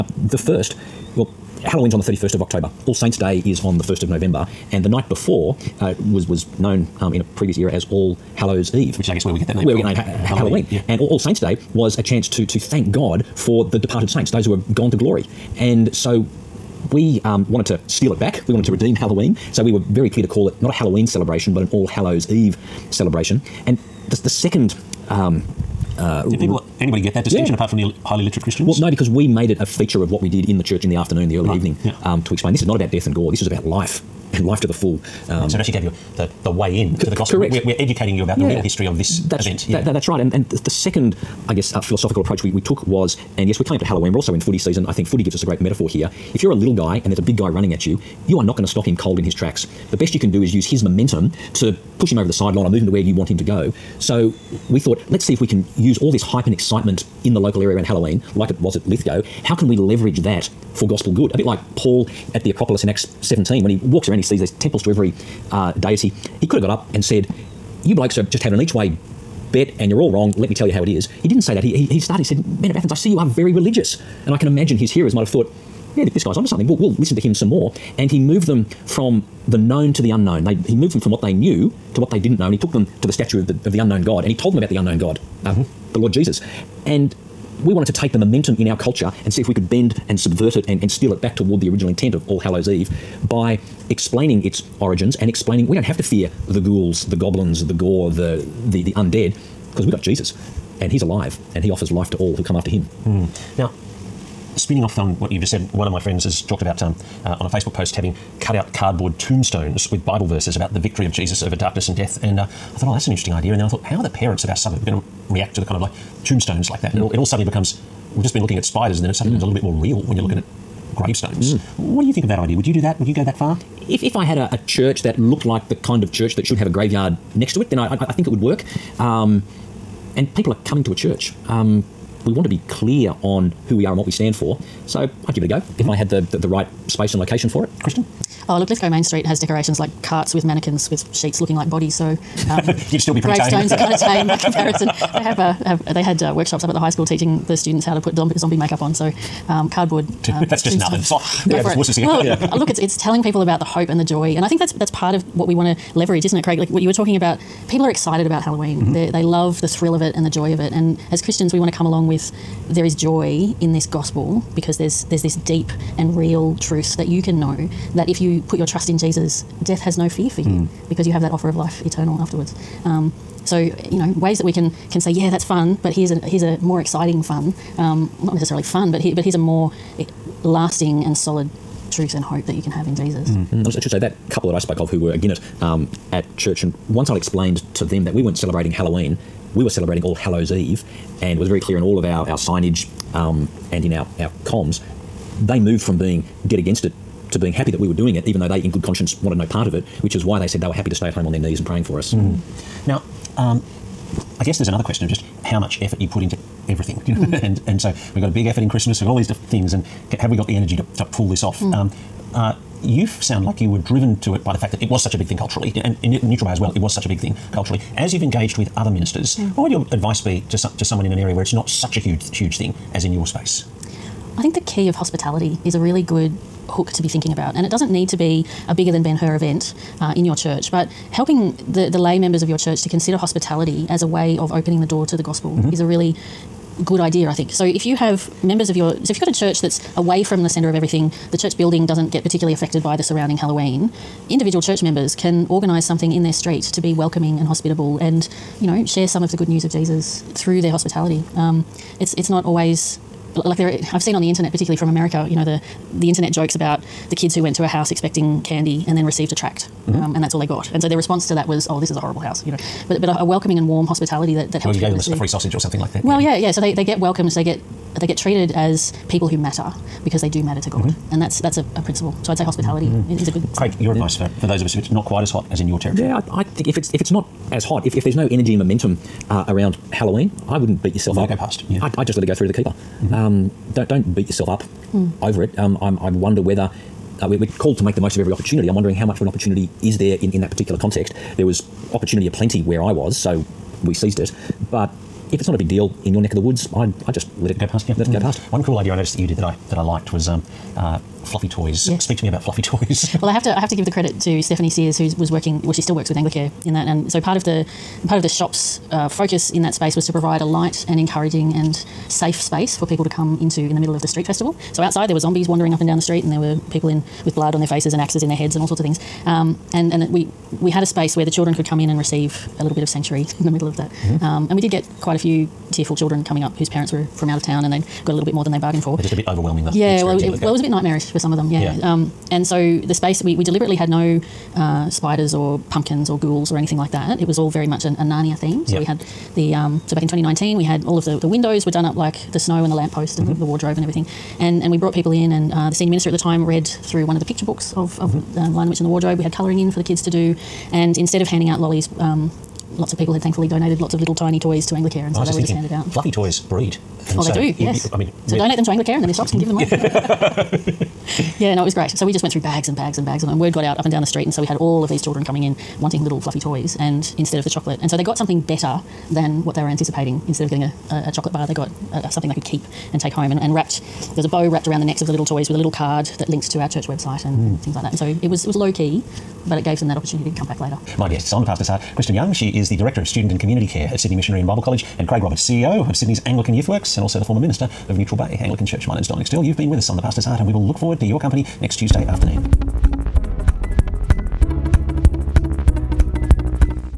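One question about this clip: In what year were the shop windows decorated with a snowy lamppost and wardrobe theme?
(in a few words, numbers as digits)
2019.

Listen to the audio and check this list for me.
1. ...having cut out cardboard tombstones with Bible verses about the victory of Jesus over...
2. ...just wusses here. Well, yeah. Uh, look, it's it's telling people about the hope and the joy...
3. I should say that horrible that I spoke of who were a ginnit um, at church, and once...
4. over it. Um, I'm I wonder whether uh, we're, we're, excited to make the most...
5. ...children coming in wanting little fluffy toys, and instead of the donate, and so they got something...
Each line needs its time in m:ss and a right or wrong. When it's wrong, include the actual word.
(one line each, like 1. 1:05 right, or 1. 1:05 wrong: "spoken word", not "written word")
1. 1:47 right
2. 2:31 right
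3. 3:03 wrong: "couple", not "horrible"
4. 4:45 wrong: "called", not "excited"
5. 6:05 wrong: "chocolate", not "donate".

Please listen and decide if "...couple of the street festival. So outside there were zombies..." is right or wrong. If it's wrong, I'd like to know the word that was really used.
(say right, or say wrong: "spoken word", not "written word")
wrong: "middle", not "couple".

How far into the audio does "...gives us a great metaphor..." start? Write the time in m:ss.
0:45.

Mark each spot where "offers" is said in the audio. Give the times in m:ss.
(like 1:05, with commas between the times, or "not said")
1:41, 2:51.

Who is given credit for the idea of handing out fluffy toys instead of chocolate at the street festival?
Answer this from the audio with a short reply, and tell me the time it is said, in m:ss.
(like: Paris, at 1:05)
Stephanie Sears, at 5:04.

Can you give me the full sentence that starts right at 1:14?
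And I can imagine his hearers might have thought, yeah, this guy's onto something.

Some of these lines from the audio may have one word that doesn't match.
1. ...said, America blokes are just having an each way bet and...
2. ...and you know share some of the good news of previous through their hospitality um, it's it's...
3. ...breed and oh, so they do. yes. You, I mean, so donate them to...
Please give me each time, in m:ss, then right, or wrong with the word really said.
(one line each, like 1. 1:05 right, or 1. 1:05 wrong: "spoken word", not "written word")
1. 1:07 wrong: "You", not "America"
2. 4:07 wrong: "jesus", not "previous"
3. 5:56 right.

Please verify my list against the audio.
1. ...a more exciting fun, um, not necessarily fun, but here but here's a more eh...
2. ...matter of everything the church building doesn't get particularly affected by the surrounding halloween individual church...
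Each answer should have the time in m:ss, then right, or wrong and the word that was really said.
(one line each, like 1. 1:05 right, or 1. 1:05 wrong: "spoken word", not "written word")
1. 2:56 right
2. 4:00 wrong: "center", not "matter".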